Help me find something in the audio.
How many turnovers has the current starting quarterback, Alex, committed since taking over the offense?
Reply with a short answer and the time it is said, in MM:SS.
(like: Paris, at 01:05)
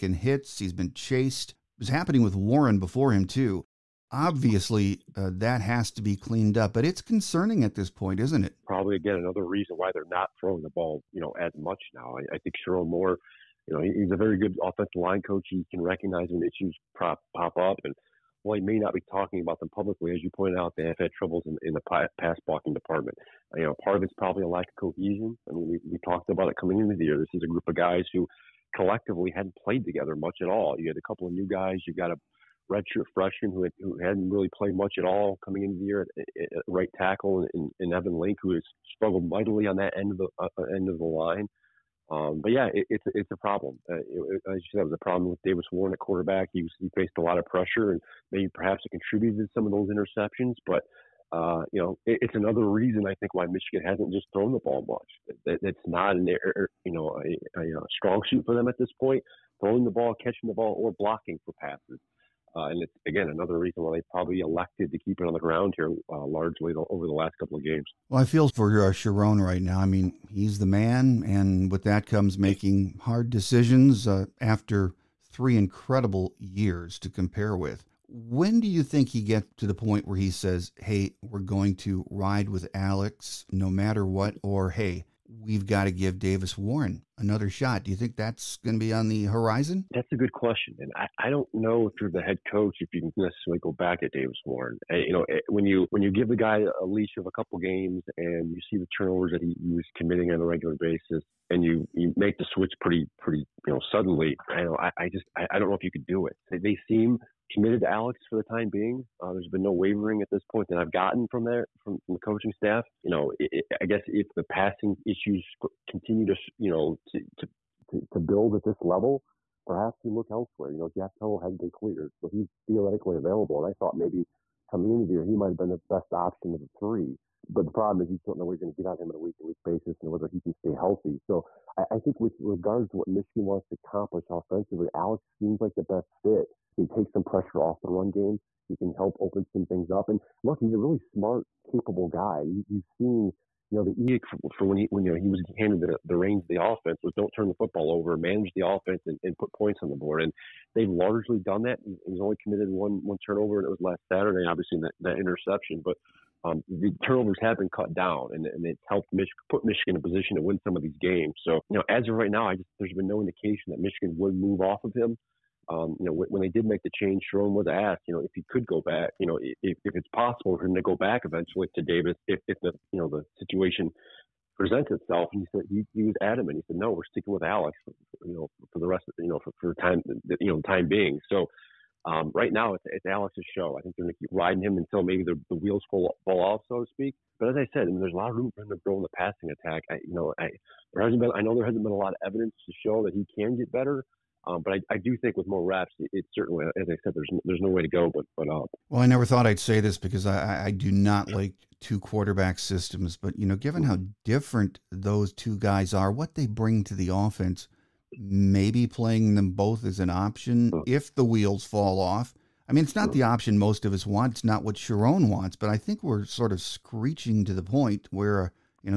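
1, at 02:32.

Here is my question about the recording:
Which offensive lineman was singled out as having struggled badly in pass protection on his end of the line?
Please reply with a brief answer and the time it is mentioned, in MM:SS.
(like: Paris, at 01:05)
Evan Link, at 00:37.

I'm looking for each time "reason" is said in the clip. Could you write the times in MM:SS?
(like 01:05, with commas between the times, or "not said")
00:09, 00:52, 01:03.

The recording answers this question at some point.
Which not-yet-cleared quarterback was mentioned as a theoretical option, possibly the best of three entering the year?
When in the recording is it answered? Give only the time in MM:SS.
02:00.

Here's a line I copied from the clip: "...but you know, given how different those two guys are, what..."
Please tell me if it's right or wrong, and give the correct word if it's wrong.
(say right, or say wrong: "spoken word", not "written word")
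right.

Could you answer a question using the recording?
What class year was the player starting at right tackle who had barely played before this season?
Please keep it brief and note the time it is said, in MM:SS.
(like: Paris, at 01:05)
redshirt freshman, at 00:32.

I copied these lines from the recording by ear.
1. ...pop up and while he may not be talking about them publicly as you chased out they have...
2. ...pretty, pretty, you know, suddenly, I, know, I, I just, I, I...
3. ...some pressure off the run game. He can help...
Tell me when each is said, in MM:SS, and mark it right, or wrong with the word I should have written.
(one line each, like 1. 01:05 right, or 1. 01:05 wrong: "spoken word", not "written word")
1. 00:17 wrong: "pointed", not "chased"
2. 01:42 right
3. 02:17 right.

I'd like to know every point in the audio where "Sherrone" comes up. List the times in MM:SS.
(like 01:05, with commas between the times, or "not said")
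00:12, 01:08, 02:47, 03:34.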